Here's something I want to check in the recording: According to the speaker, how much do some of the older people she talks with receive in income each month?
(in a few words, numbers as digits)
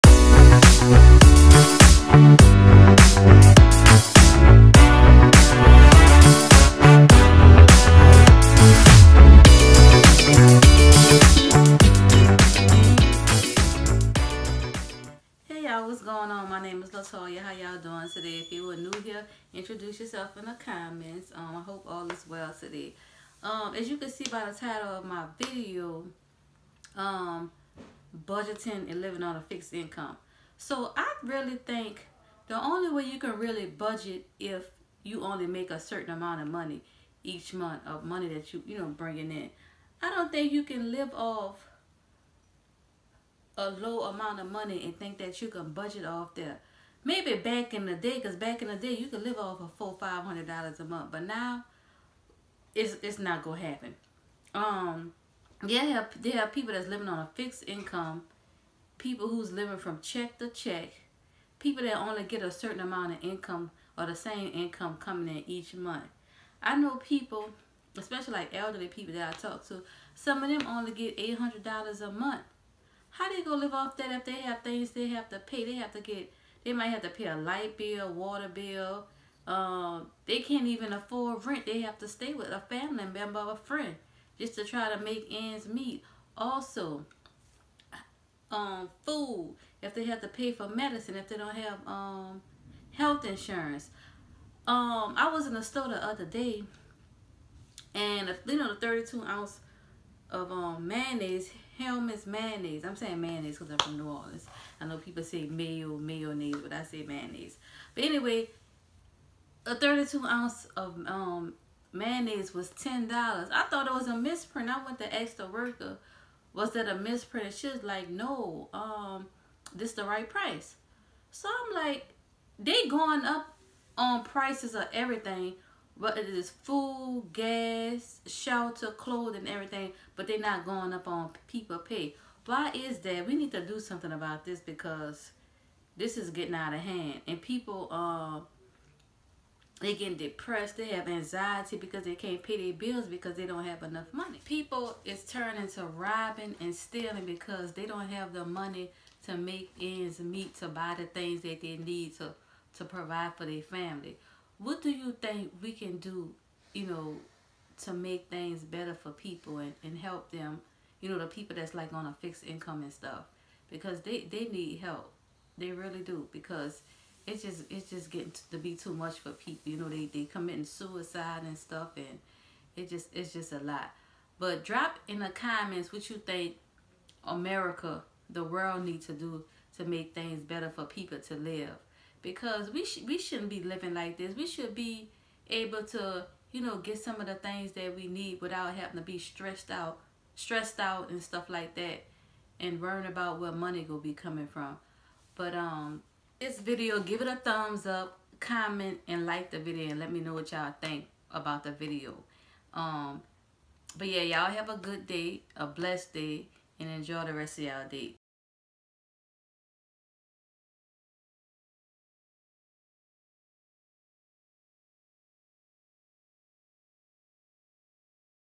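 $800.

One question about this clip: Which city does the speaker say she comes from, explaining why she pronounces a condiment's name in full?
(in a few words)
New Orleans.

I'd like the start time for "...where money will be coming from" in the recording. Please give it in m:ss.
3:13.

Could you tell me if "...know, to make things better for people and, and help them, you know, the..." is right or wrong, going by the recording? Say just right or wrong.
right.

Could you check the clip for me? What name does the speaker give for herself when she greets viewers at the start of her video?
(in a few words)
Latoya.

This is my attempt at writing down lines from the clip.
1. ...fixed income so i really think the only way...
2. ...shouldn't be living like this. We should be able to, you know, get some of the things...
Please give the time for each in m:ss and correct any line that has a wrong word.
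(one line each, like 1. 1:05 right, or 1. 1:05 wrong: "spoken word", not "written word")
1. 0:29 right
2. 3:03 right.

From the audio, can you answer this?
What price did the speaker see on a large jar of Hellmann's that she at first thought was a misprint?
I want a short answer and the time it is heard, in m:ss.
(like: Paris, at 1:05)
$10, at 1:52.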